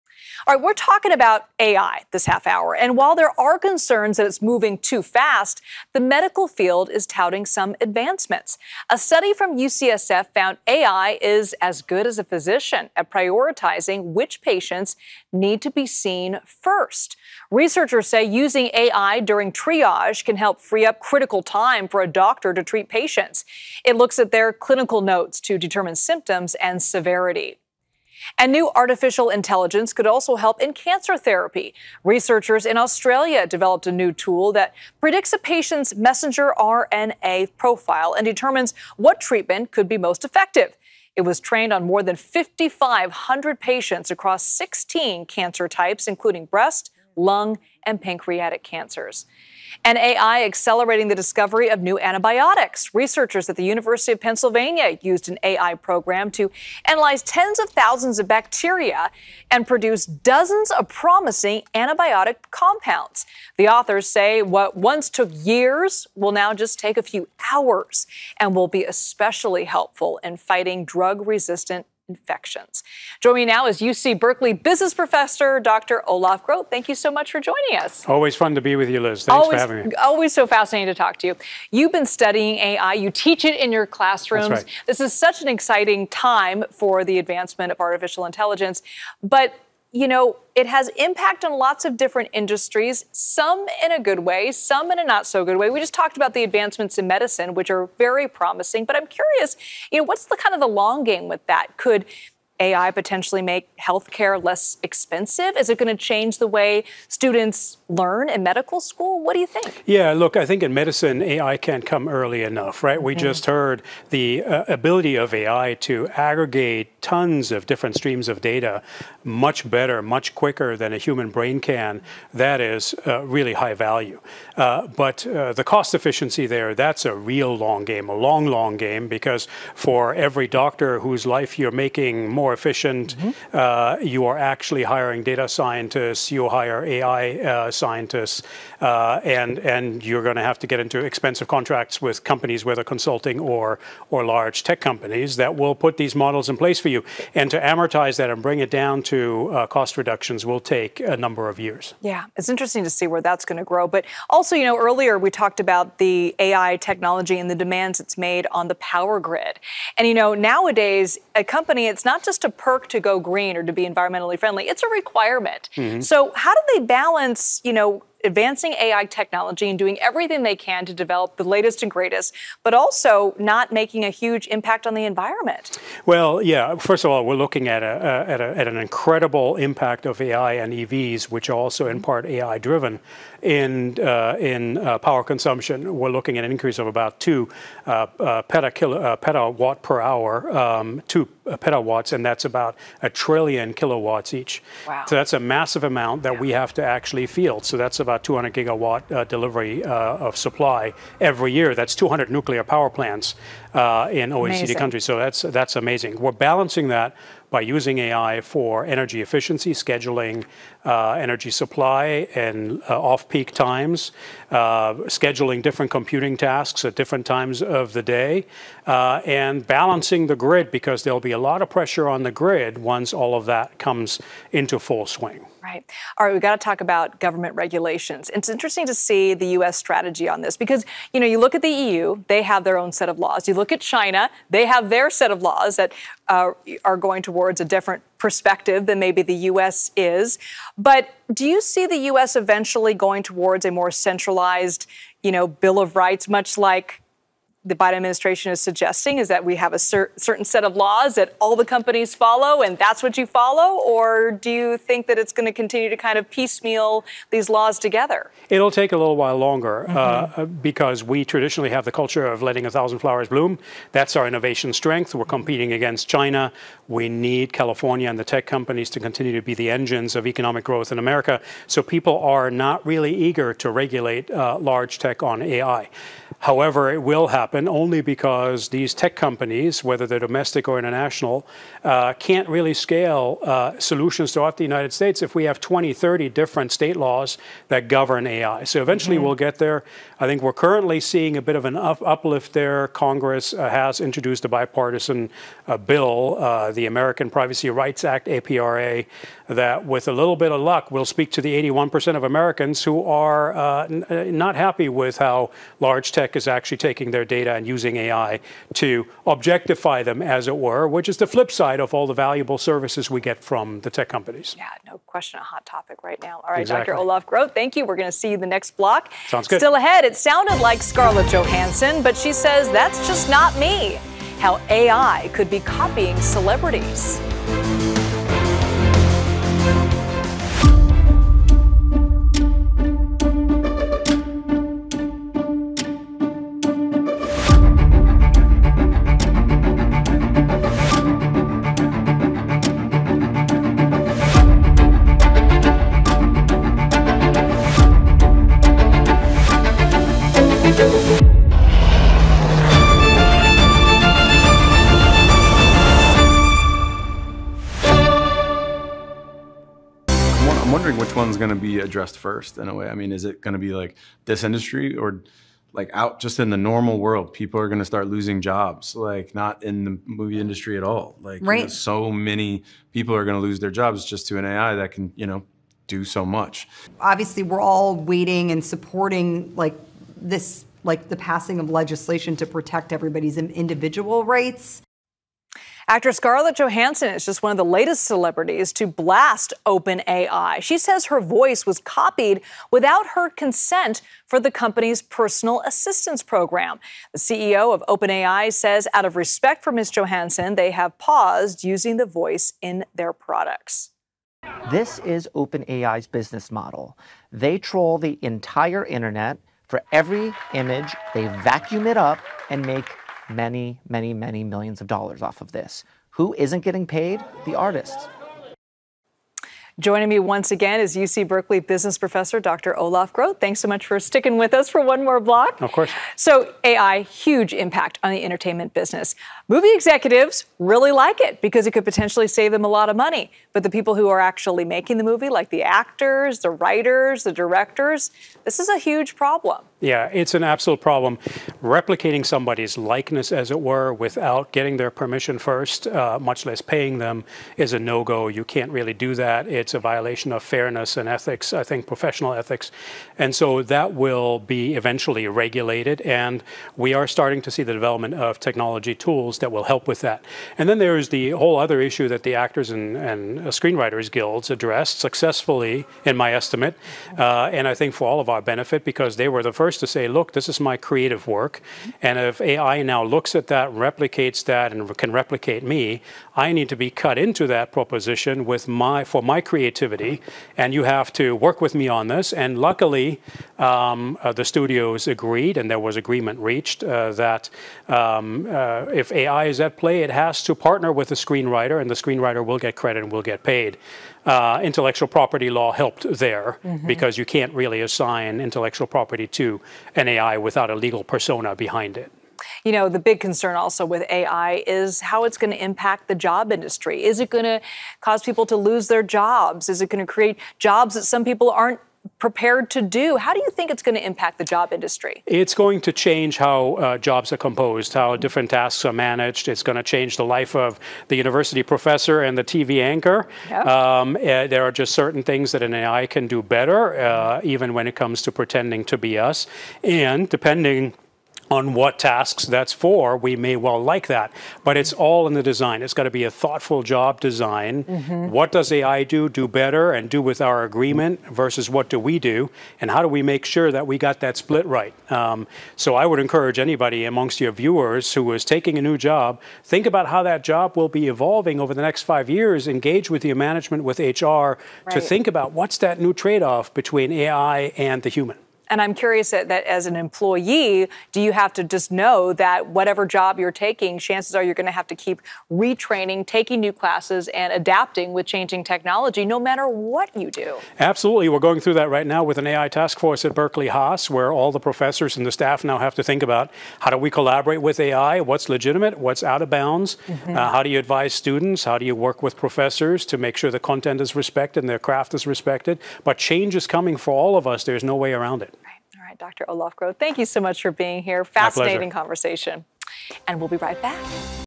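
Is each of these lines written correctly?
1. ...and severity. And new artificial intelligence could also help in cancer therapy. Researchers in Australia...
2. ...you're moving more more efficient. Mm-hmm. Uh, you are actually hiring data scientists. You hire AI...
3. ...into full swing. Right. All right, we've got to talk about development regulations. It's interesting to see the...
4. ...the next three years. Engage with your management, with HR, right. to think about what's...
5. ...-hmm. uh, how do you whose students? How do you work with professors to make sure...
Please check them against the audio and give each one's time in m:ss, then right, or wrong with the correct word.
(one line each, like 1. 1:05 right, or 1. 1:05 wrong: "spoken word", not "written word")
1. 0:26 right
2. 2:11 wrong: "making", not "moving"
3. 3:44 wrong: "government", not "development"
4. 9:11 wrong: "five", not "three"
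5. 9:40 wrong: "advise", not "whose".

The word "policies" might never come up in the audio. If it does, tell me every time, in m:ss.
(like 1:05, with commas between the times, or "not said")
not said.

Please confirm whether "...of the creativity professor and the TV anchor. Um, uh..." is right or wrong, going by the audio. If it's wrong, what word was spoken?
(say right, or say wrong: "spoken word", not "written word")
wrong: "university", not "creativity".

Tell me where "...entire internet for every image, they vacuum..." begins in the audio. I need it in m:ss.
6:48.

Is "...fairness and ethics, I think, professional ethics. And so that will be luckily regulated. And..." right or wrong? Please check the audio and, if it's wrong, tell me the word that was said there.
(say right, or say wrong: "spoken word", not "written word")
wrong: "eventually", not "luckily".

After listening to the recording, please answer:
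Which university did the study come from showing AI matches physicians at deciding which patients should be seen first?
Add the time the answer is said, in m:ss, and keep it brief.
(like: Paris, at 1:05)
UCSF, at 0:09.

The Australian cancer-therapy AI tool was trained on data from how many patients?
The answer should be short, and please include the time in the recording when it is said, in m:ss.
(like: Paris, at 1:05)
5,500, at 0:42.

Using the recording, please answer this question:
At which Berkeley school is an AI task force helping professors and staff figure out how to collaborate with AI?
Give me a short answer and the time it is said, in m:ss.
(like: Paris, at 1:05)
Berkeley Haas, at 9:33.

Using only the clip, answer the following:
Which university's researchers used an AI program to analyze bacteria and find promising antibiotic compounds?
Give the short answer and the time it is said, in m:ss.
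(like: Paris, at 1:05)
University of Pennsylvania, at 0:53.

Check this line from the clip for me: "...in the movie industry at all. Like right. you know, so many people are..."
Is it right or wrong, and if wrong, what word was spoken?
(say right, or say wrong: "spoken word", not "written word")
right.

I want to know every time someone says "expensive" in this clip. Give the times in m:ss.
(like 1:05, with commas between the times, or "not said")
1:44, 2:21.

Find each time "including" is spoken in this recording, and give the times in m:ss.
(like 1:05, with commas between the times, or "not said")
0:46.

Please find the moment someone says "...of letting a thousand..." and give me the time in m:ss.
4:22.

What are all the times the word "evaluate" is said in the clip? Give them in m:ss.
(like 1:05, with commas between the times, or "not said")
not said.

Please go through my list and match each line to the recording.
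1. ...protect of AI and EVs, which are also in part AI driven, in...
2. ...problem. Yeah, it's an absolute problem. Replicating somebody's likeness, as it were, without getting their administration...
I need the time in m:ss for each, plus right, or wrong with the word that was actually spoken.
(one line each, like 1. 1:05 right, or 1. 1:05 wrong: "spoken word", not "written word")
1. 2:59 wrong: "impact", not "protect"
2. 7:19 wrong: "permission", not "administration".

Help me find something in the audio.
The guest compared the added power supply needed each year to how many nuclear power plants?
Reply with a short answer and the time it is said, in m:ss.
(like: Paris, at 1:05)
200, at 3:21.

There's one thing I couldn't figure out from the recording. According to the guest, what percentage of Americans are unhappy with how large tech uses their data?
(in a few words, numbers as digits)
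81%.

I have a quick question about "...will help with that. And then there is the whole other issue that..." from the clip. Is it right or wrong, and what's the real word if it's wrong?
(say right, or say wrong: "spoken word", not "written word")
right.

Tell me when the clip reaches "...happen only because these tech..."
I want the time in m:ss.
4:37.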